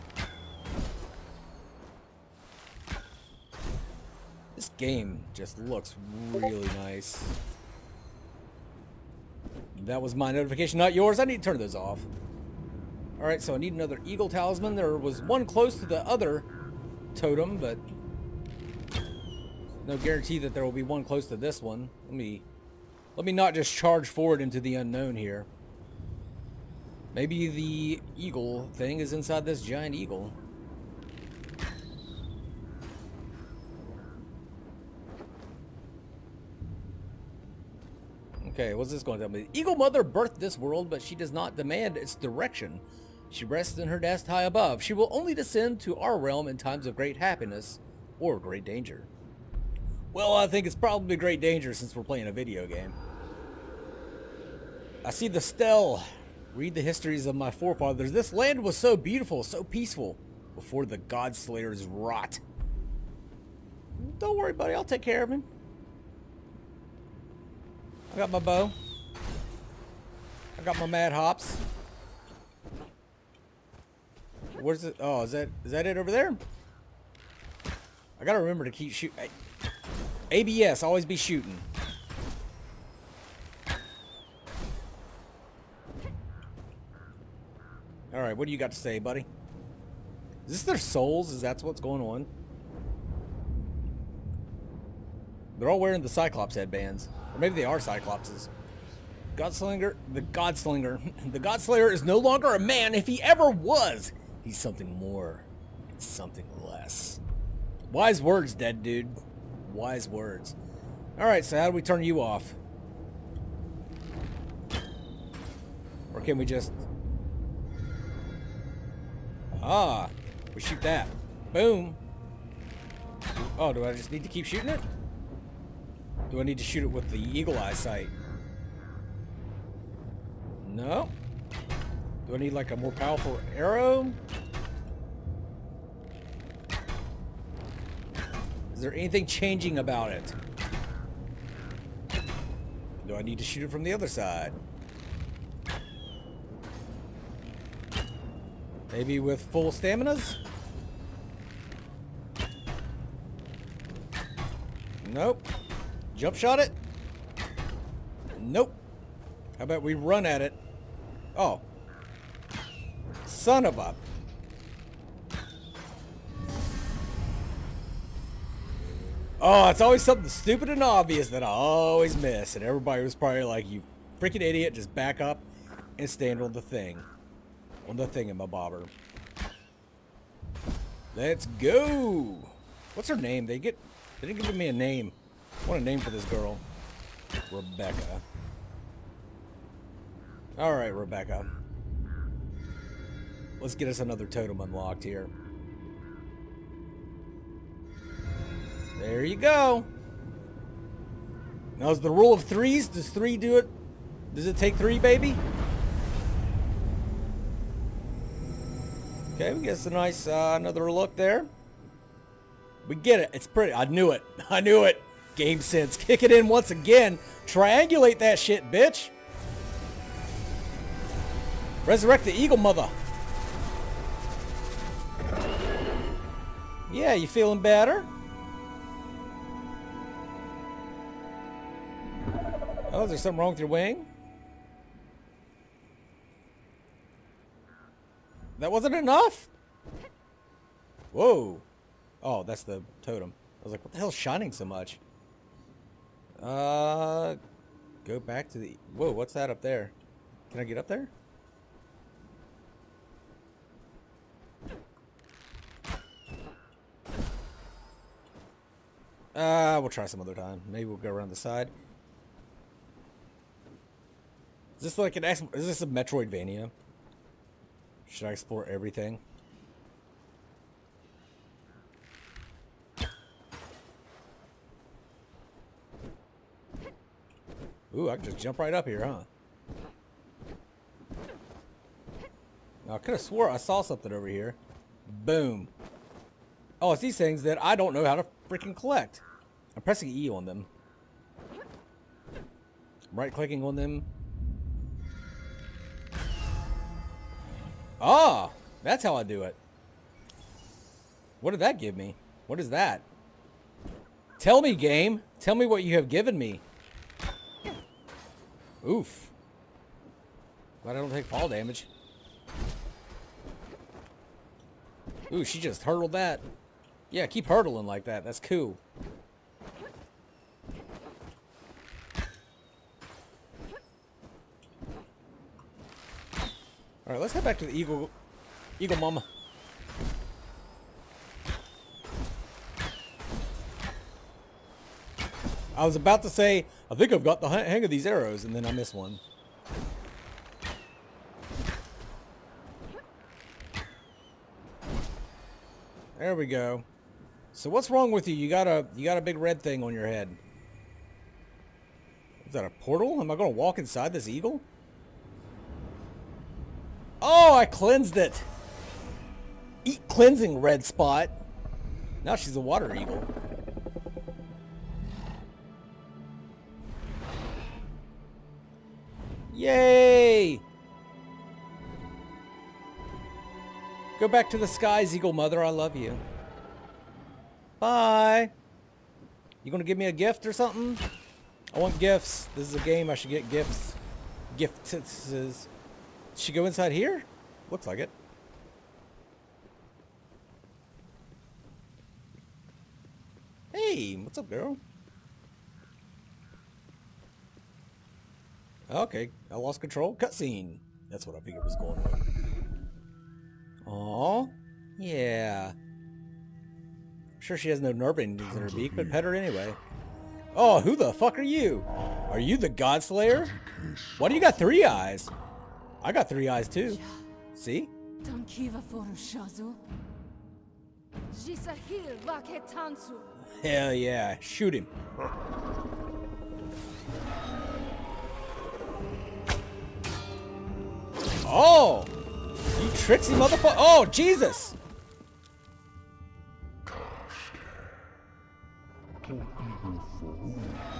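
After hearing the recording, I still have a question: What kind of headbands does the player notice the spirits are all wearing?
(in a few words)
Cyclops headbands.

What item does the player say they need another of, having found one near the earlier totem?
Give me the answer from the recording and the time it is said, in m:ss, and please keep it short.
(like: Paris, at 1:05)
Eagle Talisman, at 0:14.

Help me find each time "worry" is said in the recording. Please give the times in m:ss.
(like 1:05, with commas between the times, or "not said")
1:04.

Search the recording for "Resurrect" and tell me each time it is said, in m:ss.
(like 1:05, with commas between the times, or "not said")
3:41.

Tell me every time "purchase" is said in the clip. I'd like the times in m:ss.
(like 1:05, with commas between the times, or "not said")
not said.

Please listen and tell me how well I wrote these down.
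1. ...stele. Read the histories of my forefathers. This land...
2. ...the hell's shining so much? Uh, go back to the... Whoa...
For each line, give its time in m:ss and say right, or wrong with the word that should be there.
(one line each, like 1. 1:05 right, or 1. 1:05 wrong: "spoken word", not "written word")
1. 0:55 right
2. 4:03 right.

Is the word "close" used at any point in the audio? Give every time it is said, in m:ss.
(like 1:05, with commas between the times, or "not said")
0:15, 0:21.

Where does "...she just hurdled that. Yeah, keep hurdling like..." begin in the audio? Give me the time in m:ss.
5:15.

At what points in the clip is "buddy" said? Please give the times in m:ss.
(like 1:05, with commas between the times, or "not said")
1:04, 1:29.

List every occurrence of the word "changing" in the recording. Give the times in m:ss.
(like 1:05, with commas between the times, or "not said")
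2:19.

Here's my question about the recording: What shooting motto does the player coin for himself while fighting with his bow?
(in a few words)
Always be shooting.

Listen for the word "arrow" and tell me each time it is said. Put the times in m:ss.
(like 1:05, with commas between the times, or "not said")
2:13, 5:38.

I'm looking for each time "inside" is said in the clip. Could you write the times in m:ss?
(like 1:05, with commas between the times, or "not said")
0:29, 5:53, 6:26.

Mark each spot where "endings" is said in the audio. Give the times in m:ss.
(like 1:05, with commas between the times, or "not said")
6:48.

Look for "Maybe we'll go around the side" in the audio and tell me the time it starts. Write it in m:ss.
4:20.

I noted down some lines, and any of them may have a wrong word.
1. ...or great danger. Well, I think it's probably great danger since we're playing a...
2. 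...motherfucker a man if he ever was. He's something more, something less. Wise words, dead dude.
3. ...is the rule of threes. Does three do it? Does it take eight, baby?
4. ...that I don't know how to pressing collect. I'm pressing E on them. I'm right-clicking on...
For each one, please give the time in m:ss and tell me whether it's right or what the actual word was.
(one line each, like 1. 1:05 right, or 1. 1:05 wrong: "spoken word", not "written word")
1. 0:48 right
2. 1:42 wrong: "longer", not "motherfucker"
3. 3:21 wrong: "three", not "eight"
4. 4:47 wrong: "freaking", not "pressing".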